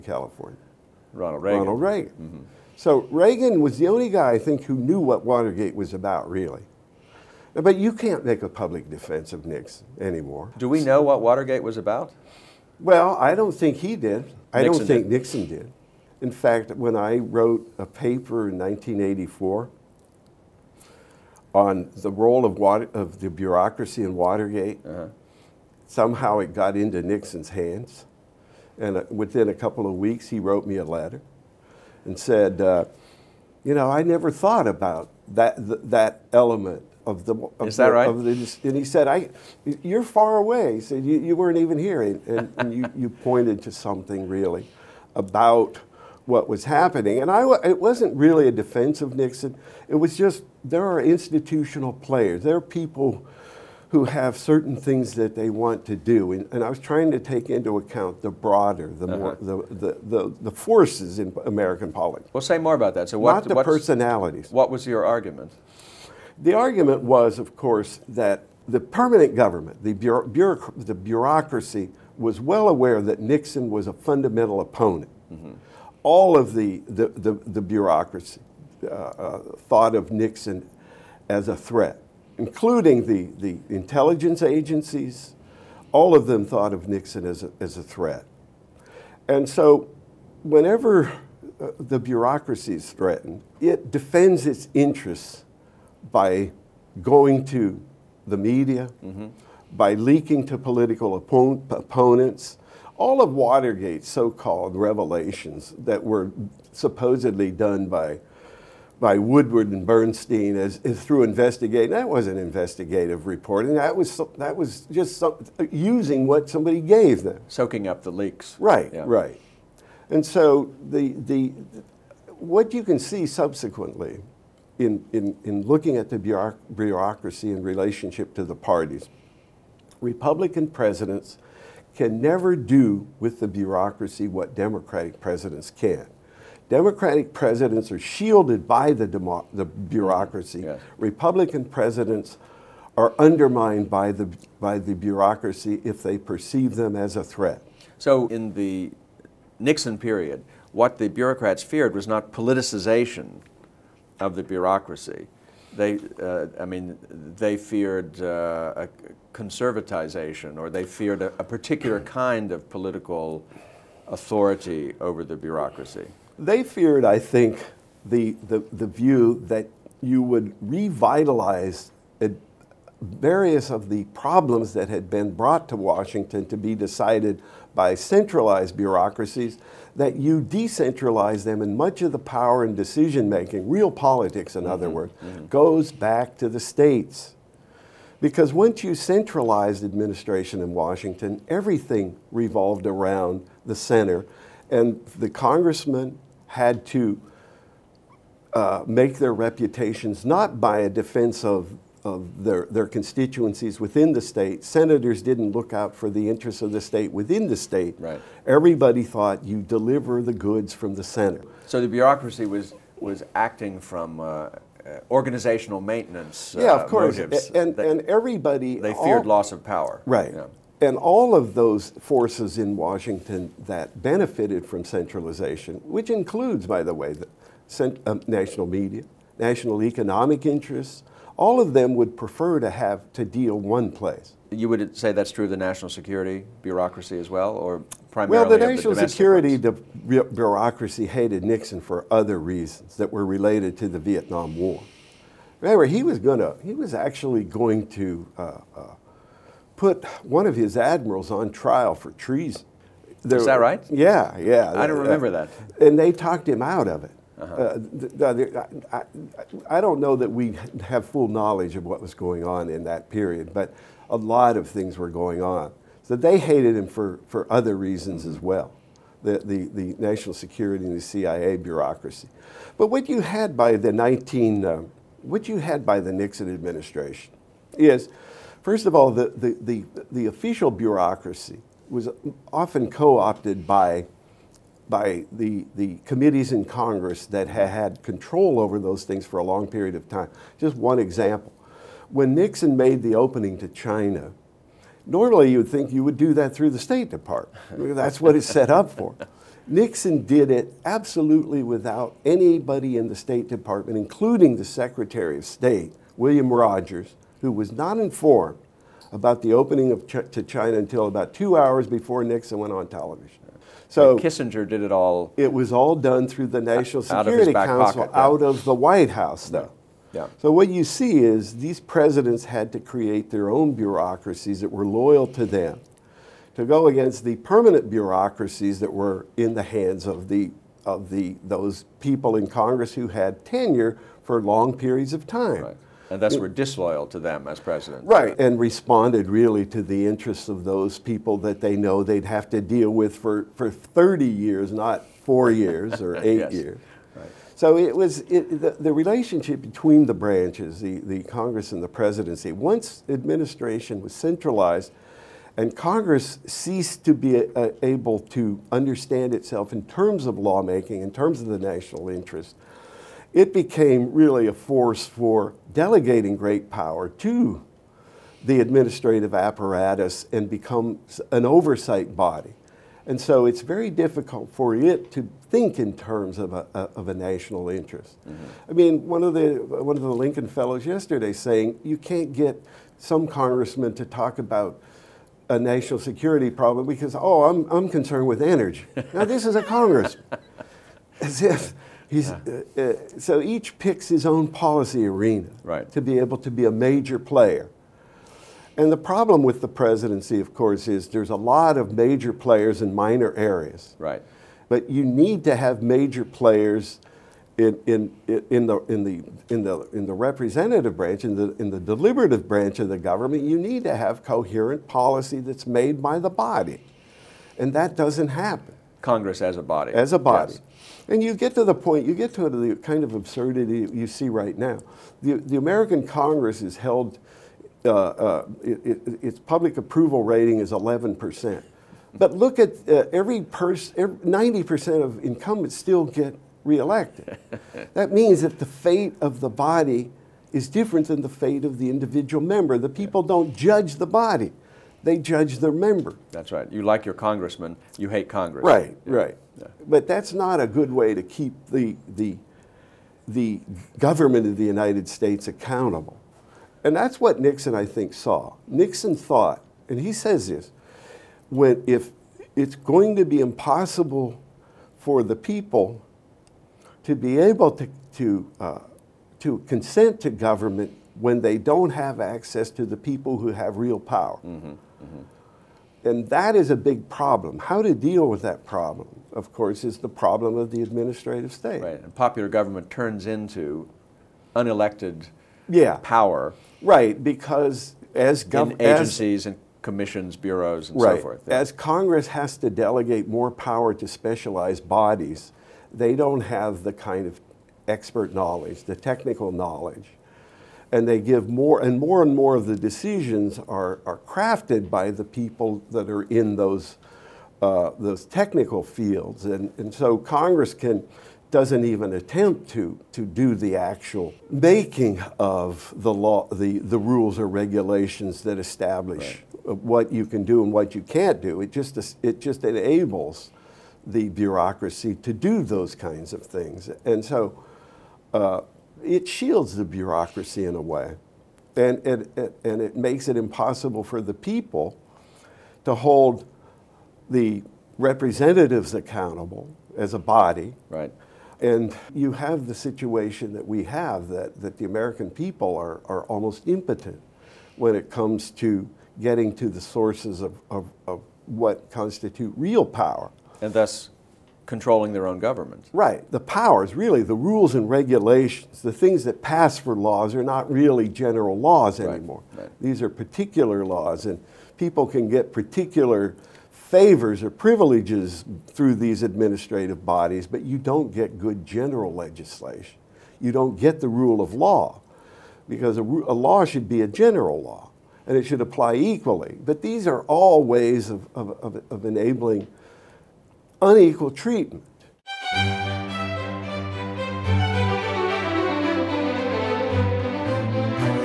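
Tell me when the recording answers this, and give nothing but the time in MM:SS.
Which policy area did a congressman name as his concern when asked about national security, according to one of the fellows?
06:28.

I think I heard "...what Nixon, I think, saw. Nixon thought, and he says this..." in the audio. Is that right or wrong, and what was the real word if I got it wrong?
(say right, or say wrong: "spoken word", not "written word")
right.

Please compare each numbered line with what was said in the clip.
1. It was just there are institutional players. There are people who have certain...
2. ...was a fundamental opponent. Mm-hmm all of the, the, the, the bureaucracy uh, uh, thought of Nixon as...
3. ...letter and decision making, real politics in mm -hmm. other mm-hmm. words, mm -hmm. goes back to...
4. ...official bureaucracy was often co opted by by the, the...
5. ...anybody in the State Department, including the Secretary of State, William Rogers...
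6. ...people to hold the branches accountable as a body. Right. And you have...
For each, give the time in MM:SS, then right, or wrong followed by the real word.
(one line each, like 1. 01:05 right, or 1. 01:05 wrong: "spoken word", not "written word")
1. 00:49 right
2. 01:13 right
3. 03:02 wrong: "power", not "letter"
4. 04:40 right
5. 05:02 right
6. 08:54 wrong: "representatives", not "branches".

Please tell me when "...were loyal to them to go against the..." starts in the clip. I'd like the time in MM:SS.
05:24.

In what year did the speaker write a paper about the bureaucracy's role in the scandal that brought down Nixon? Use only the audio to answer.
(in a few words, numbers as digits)
1984.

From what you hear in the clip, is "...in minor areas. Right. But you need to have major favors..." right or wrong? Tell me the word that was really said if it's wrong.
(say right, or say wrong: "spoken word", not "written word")
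wrong: "players", not "favors".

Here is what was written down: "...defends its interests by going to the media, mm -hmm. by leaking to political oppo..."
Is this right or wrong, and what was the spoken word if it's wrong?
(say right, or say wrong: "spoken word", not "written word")
right.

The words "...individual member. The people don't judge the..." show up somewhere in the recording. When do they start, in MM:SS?
07:21.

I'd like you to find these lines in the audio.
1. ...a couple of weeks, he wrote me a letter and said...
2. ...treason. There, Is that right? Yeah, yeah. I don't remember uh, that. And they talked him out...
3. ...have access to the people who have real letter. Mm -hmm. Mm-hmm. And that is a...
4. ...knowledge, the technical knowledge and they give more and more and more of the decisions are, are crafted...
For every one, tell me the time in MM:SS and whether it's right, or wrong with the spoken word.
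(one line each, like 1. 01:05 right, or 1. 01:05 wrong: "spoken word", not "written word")
1. 00:29 right
2. 04:12 right
3. 07:51 wrong: "power", not "letter"
4. 08:18 right.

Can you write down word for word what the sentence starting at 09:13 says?
And thus controlling their own government.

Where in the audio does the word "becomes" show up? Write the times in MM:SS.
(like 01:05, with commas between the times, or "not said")
06:10.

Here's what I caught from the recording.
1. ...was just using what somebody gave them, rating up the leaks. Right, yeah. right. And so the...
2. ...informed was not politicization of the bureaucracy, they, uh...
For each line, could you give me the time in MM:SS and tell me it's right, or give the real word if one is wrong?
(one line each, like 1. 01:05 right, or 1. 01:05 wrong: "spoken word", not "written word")
1. 01:54 wrong: "soaking", not "rating"
2. 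02:31 wrong: "feared", not "informed".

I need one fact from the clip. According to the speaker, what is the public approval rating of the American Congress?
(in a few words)
11%.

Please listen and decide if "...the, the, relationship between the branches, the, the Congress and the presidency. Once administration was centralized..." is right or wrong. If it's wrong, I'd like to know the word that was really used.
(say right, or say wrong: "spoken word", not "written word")
right.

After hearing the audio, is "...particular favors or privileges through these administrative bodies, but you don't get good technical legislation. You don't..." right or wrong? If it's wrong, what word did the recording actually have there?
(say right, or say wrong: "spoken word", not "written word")
wrong: "general", not "technical".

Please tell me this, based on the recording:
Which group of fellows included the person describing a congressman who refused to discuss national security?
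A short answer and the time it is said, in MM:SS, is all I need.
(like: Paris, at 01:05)
Lincoln Fellows, at 06:20.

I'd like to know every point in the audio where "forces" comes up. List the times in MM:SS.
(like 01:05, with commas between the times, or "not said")
01:00, 03:41, 06:04.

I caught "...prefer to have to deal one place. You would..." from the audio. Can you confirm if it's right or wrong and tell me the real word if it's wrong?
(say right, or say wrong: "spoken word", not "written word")
right.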